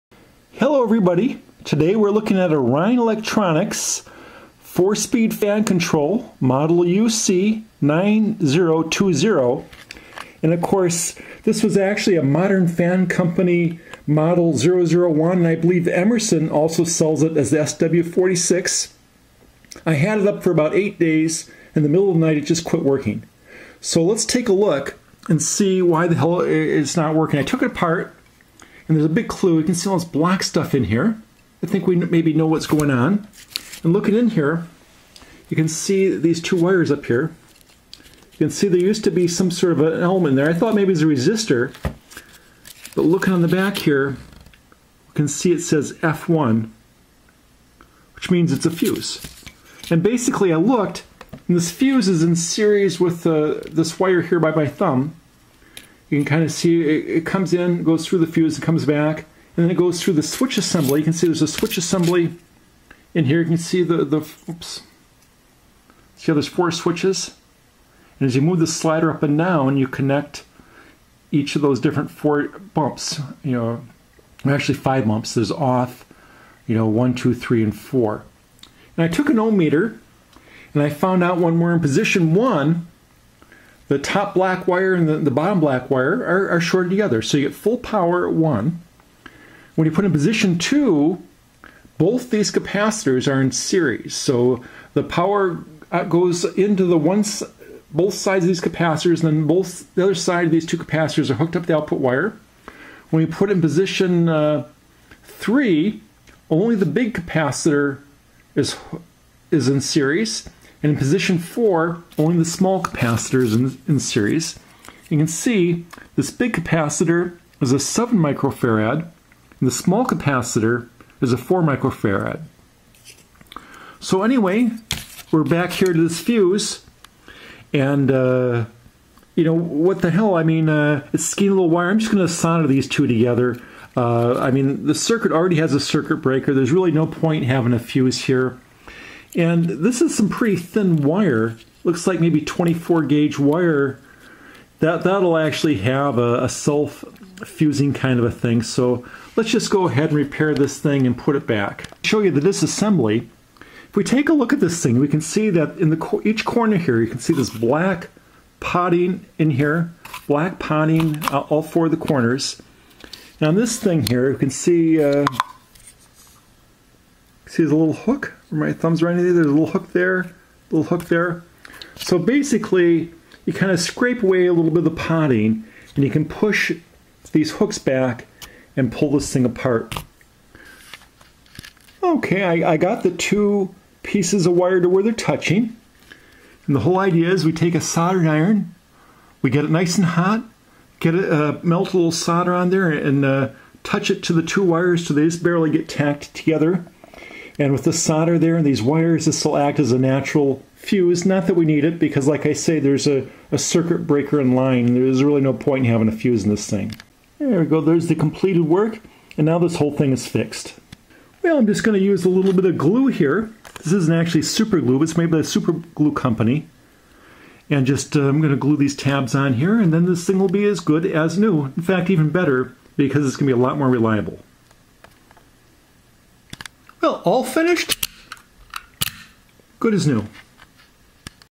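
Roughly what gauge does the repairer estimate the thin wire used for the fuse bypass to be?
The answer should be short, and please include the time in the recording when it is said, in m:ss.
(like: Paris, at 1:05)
24 gauge, at 2:22.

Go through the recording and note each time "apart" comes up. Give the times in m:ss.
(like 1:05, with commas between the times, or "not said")
0:27, 2:59.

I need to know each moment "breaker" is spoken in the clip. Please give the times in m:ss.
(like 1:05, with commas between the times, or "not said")
2:16, 3:24.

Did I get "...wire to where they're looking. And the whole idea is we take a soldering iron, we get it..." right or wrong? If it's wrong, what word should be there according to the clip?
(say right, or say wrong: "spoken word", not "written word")
wrong: "touching", not "looking".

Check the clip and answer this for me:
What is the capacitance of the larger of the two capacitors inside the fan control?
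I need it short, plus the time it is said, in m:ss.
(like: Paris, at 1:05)
7 microfarad, at 1:57.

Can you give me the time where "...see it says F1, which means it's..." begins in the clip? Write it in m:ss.
0:45.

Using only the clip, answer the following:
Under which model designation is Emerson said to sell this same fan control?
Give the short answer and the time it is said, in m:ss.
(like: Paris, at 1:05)
SW46, at 0:17.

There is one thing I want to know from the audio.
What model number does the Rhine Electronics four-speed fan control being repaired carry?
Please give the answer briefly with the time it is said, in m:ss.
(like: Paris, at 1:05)
UC9020, at 0:06.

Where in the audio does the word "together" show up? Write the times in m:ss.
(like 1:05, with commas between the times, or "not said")
1:26, 2:13, 3:16.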